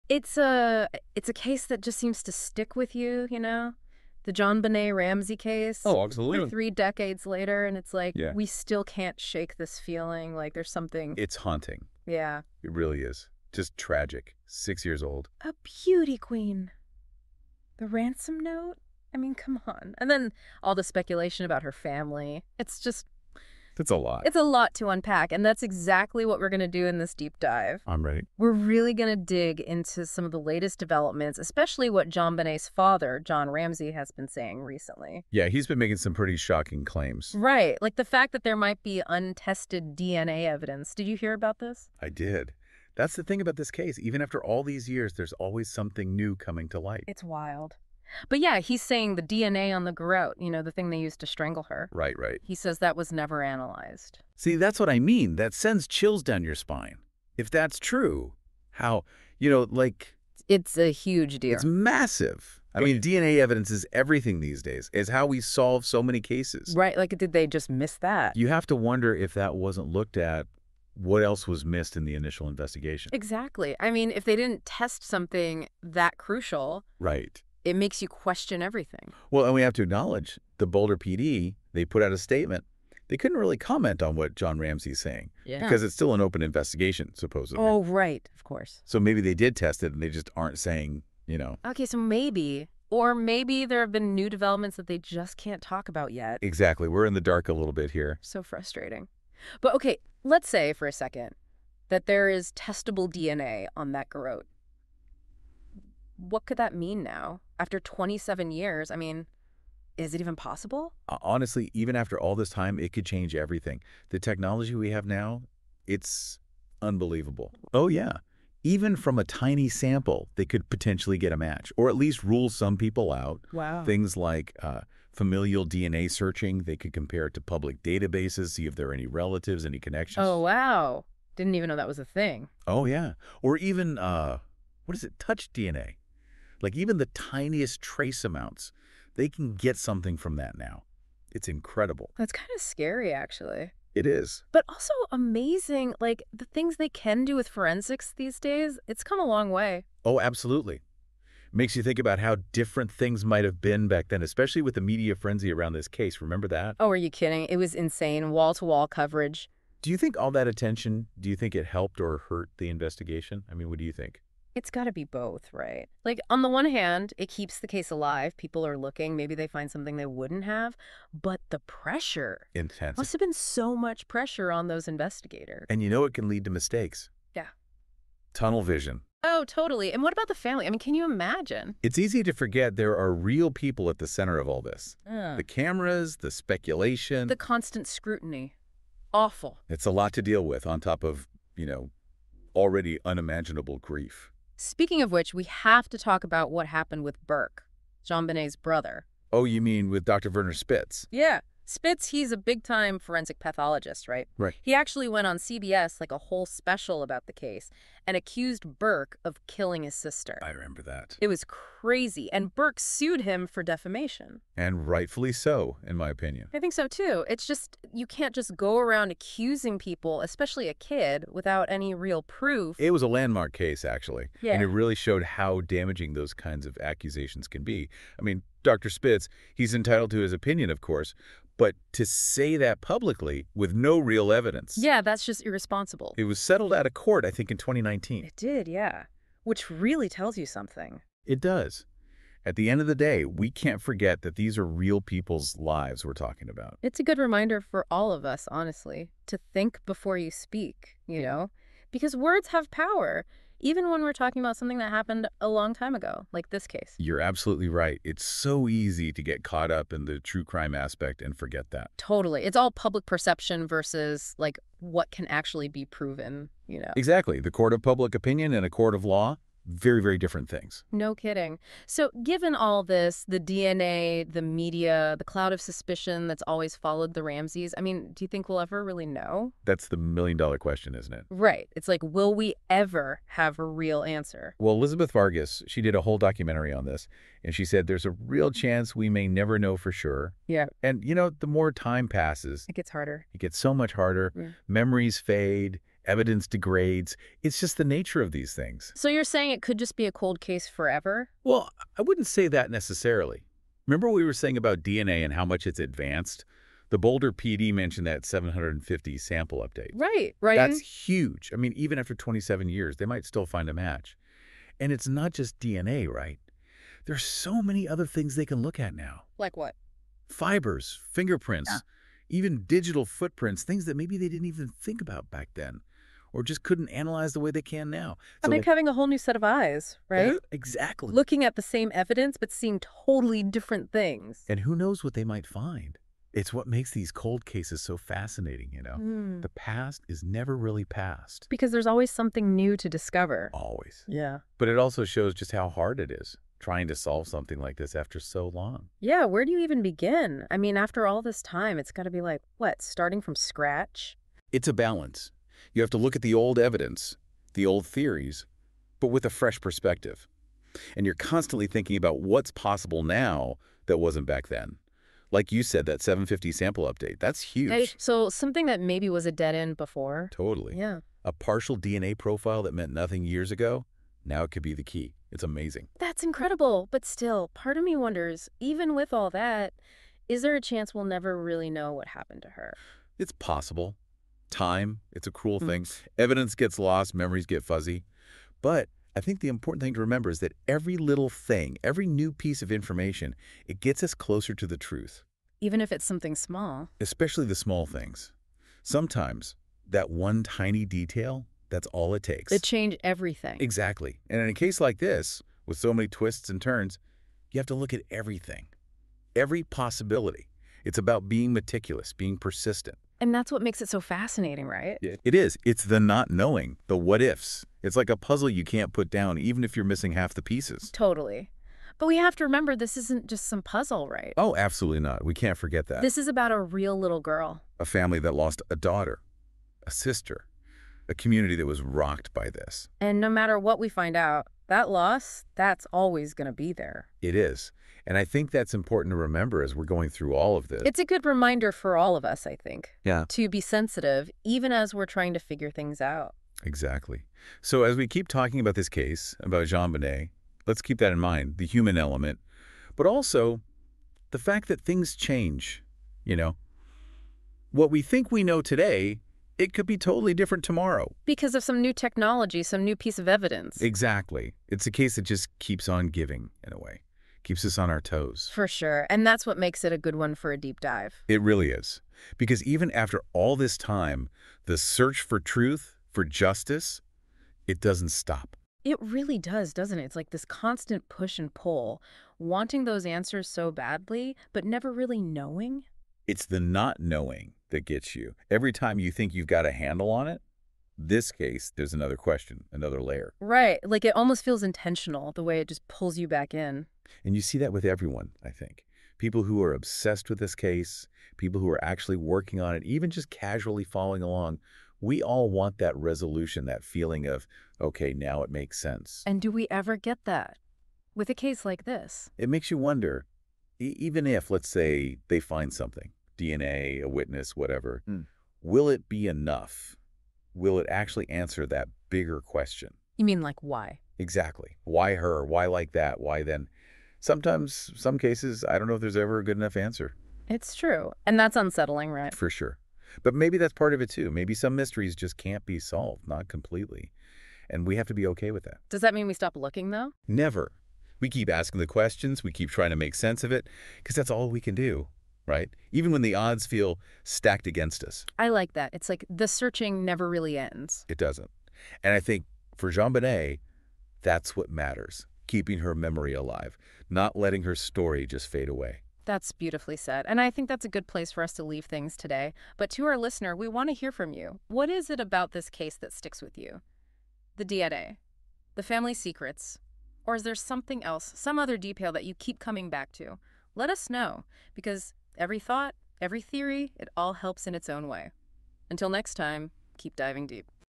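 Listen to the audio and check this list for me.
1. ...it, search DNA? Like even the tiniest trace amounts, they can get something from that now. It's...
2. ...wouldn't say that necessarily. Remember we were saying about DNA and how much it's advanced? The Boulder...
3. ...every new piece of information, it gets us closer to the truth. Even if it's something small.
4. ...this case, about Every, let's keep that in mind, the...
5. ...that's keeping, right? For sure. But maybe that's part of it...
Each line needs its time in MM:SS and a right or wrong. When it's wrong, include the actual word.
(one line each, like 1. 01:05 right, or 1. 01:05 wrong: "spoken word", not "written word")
1. 02:15 wrong: "touch", not "search"
2. 05:02 right
3. 06:31 right
4. 07:28 wrong: "JonBenét", not "Every"
5. 08:51 wrong: "unsettling", not "keeping".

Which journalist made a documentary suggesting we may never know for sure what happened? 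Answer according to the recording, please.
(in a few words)
Elizabeth Vargas.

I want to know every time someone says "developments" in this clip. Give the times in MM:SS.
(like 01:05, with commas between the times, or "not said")
00:30, 01:34.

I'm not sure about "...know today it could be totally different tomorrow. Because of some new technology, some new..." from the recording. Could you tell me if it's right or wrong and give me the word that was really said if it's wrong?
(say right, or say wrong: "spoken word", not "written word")
right.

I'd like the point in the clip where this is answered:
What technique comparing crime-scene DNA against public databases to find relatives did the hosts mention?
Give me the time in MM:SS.
02:05.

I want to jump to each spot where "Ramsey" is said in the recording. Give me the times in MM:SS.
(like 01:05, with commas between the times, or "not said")
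00:04, 00:33, 01:24, 04:37.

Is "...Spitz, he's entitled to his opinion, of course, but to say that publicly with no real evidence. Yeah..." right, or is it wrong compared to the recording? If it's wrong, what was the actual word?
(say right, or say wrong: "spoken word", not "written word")
right.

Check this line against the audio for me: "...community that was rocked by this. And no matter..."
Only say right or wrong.
right.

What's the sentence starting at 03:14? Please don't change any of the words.
Speaking of which, we have to talk about what happened with Burke, JonBenét's brother.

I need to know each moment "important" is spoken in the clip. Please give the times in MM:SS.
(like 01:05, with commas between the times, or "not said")
06:29, 07:18.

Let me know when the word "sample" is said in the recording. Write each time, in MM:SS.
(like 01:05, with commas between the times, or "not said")
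01:59, 05:09, 06:06.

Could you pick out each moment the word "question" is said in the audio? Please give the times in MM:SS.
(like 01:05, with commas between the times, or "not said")
01:18, 04:40, 08:12, 08:42, 09:01.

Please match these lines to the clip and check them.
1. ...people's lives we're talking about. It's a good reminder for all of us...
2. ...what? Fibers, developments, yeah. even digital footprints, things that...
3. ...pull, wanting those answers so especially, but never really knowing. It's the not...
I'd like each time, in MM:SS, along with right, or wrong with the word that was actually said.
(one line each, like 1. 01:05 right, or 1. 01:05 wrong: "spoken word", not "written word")
1. 04:05 right
2. 05:19 wrong: "fingerprints", not "developments"
3. 08:01 wrong: "badly", not "especially".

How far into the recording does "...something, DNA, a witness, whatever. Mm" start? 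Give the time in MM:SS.
08:35.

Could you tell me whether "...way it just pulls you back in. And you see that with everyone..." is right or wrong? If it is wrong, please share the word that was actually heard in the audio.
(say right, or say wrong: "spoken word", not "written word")
right.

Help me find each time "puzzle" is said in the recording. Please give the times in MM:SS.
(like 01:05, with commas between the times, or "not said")
06:58, 07:03.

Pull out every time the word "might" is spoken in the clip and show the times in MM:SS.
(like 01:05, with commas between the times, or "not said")
00:38, 02:33, 05:13, 05:35.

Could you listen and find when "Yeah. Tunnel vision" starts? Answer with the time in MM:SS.
02:57.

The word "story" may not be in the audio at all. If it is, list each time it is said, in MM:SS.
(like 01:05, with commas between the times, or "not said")
09:17.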